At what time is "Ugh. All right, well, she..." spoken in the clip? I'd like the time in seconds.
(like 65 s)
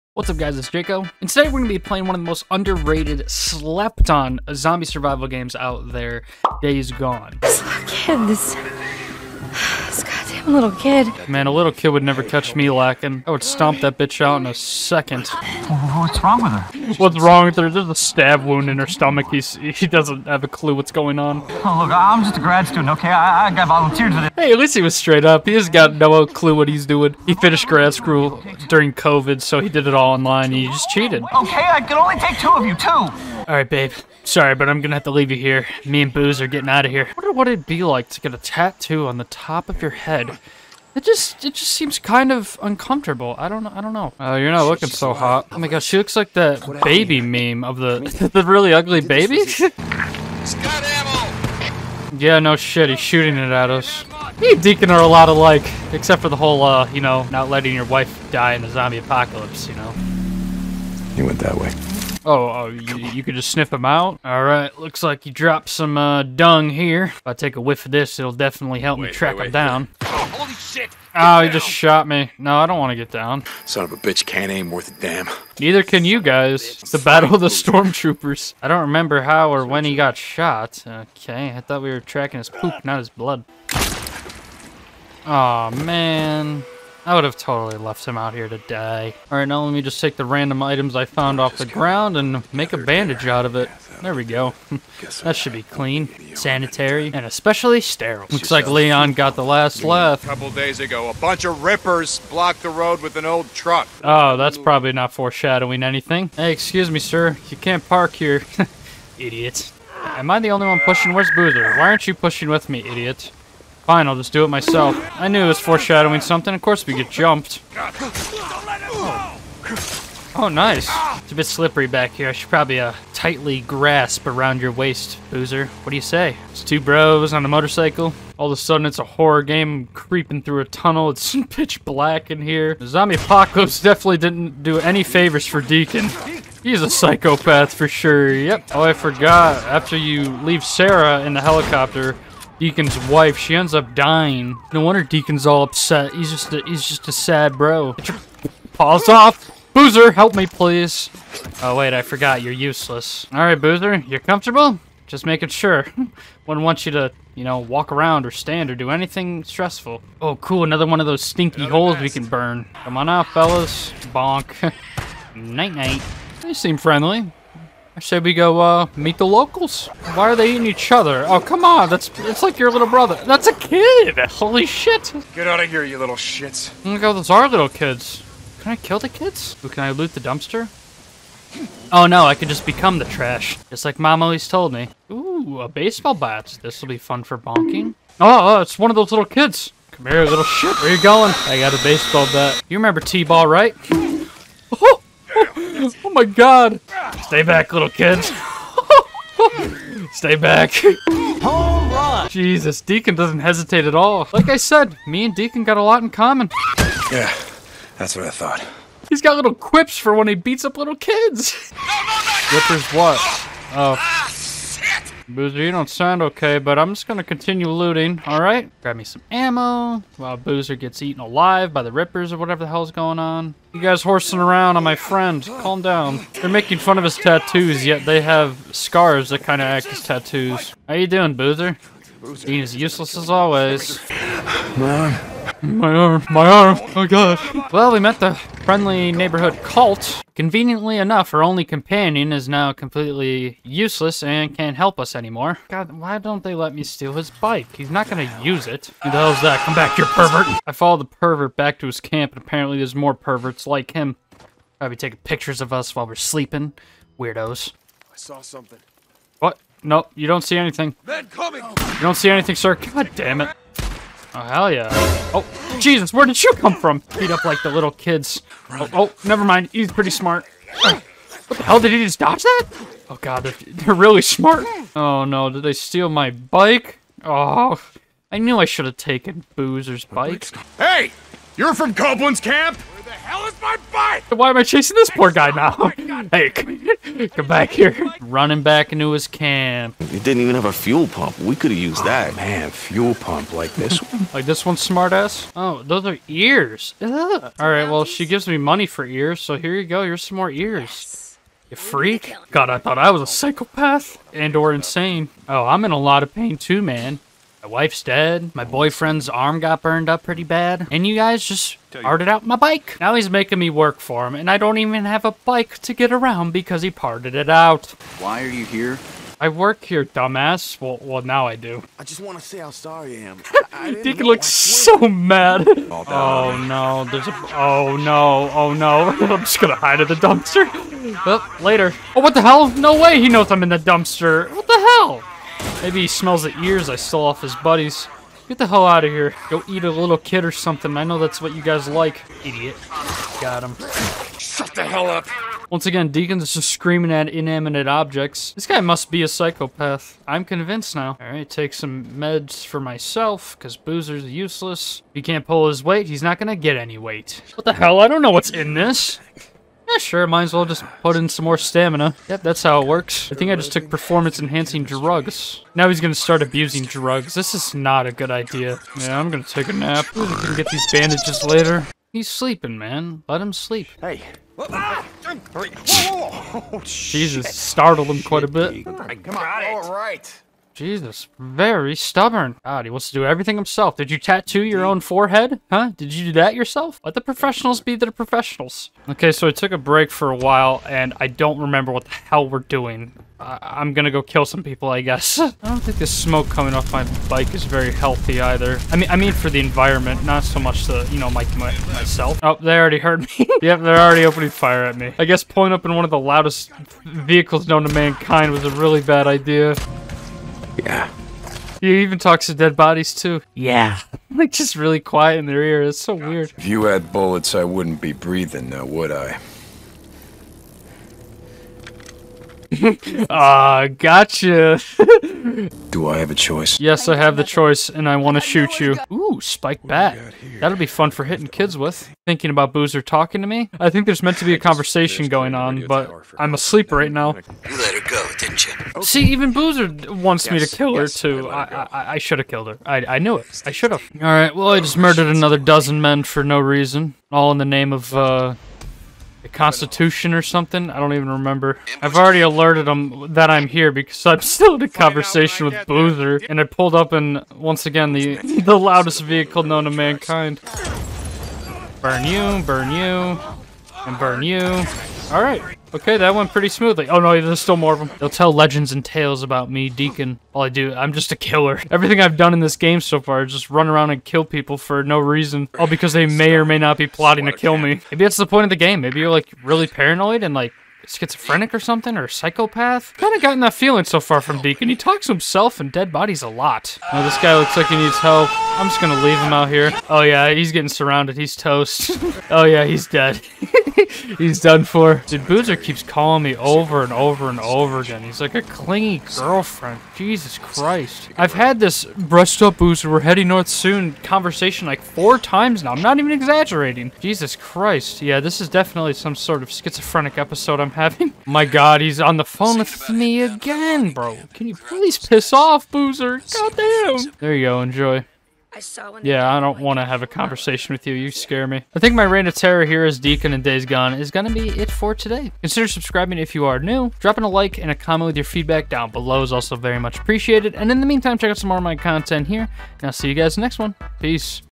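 297 s.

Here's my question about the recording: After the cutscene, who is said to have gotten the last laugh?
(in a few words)
Leon.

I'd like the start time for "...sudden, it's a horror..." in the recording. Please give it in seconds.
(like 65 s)
128 s.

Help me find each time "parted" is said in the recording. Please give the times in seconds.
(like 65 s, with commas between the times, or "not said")
311 s, 316 s.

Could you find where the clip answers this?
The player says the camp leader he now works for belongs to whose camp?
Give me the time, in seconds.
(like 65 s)
281 s.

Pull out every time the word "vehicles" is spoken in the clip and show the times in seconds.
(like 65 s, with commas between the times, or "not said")
407 s, 459 s.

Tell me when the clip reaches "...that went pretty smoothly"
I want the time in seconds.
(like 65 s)
466 s.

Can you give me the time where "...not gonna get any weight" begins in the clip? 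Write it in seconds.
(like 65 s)
356 s.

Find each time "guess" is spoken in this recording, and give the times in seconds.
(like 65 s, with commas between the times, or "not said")
395 s, 405 s.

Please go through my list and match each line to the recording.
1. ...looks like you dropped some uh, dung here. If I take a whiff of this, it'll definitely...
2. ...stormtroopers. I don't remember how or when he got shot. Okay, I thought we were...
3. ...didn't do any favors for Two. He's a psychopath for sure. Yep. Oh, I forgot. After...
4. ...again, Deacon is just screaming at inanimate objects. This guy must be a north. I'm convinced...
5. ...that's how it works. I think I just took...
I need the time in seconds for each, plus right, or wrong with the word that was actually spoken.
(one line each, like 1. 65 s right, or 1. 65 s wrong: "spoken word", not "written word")
1. 64 s right
2. 77 s right
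3. 134 s wrong: "Deacon", not "Two"
4. 345 s wrong: "psychopath", not "north"
5. 362 s right.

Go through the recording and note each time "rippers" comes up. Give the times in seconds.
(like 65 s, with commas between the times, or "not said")
101 s, 221 s.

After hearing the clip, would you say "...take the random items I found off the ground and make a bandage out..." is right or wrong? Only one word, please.
right.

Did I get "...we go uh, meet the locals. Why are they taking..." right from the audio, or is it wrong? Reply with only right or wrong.
wrong.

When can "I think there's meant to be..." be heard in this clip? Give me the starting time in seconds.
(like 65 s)
433 s.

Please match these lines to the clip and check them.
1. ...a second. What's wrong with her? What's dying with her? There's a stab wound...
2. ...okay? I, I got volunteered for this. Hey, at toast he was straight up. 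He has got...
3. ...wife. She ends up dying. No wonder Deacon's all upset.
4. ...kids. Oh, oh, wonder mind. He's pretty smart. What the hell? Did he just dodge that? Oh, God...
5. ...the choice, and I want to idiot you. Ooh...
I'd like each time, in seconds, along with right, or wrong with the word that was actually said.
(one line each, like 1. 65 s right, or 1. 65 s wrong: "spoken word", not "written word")
1. 14 s wrong: "wrong", not "dying"
2. 22 s wrong: "least", not "toast"
3. 143 s right
4. 267 s wrong: "never", not "wonder"
5. 427 s wrong: "shoot", not "idiot".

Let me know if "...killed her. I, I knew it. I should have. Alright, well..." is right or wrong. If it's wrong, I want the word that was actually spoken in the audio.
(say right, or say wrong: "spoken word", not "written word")
right.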